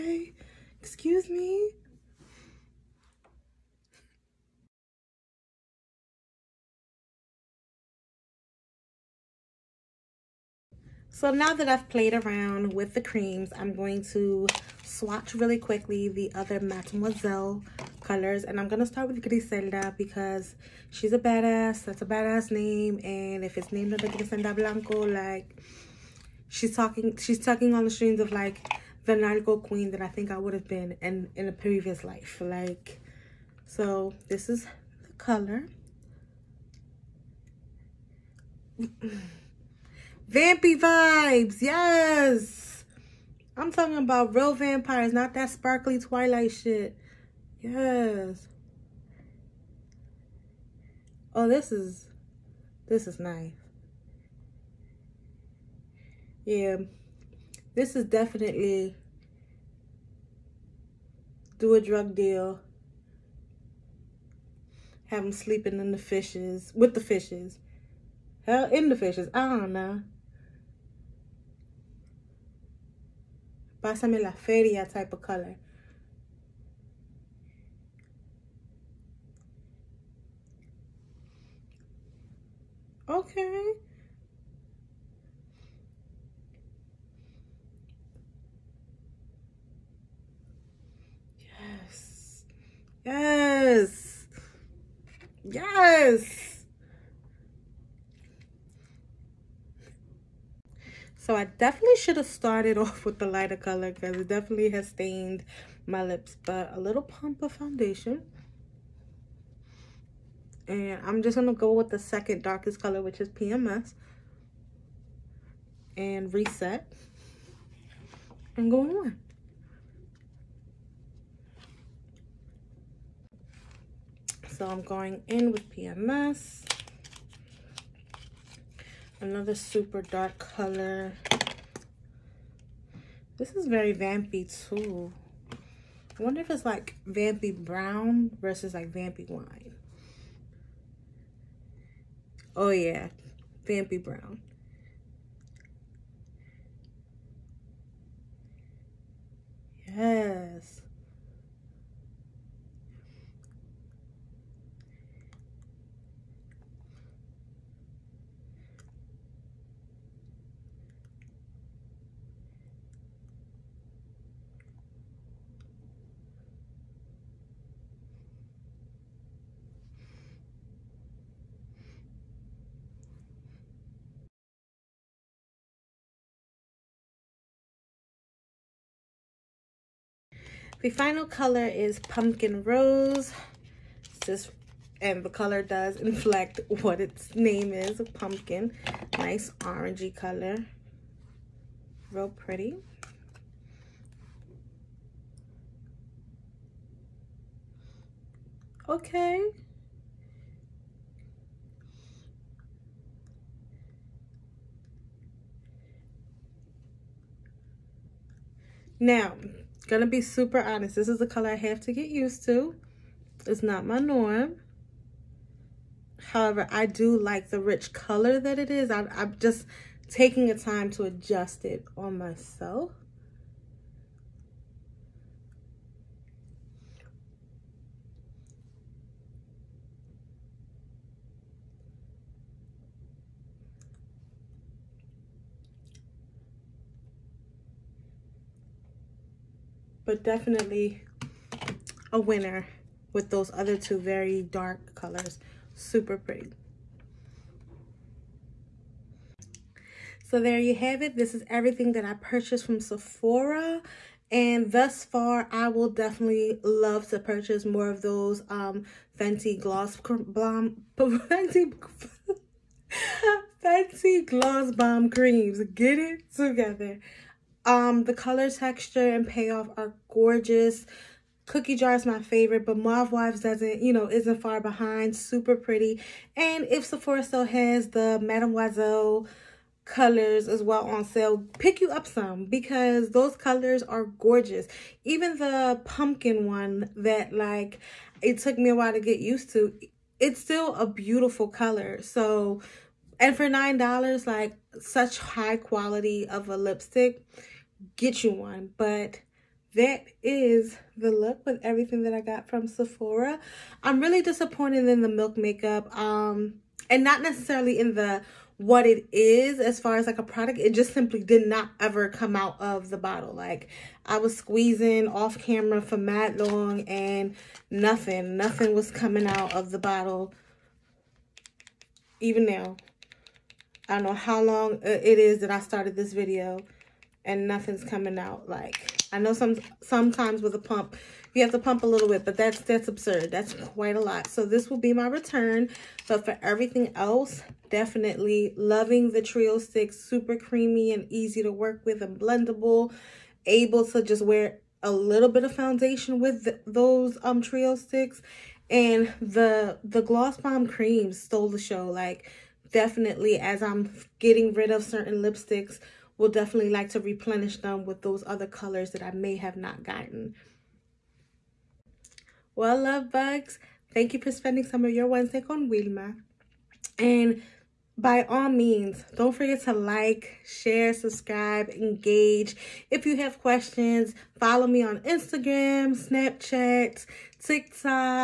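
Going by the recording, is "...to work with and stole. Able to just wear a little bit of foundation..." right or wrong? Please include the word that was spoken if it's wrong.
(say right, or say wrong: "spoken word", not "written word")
wrong: "blendable", not "stole".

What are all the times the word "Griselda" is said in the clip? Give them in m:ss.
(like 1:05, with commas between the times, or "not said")
0:19, 0:24.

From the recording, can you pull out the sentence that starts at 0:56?
Yeah, this is definitely do a drug deal.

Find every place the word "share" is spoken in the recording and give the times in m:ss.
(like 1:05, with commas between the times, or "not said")
6:10.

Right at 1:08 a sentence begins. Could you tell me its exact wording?
Hell, in the fishes, I don't know.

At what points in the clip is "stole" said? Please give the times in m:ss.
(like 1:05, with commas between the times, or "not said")
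5:51.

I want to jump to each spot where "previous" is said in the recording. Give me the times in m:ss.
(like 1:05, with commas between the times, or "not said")
0:31.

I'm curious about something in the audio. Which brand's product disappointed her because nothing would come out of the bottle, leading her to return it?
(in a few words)
Milk Makeup.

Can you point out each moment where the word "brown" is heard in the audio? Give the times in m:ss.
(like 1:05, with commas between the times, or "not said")
2:17, 2:24.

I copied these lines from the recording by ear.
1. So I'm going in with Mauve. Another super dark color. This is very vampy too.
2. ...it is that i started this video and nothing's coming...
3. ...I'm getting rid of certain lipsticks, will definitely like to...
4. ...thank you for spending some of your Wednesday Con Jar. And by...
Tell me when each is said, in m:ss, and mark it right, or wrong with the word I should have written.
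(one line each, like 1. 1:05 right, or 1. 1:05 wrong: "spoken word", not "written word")
1. 2:04 wrong: "PMS", not "Mauve"
2. 5:25 right
3. 5:53 right
4. 6:03 wrong: "Wilma", not "Jar".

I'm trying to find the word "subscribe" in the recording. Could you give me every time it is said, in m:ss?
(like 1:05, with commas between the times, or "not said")
6:10.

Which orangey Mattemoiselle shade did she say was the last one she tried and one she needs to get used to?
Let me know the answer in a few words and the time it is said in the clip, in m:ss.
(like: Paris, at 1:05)
Pumpkin Rose, at 3:01.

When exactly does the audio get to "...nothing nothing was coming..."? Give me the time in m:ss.
5:17.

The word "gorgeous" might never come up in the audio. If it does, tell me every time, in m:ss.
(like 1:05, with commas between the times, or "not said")
4:30, 4:44.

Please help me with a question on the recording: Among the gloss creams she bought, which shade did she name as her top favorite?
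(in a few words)
Cookie Jar.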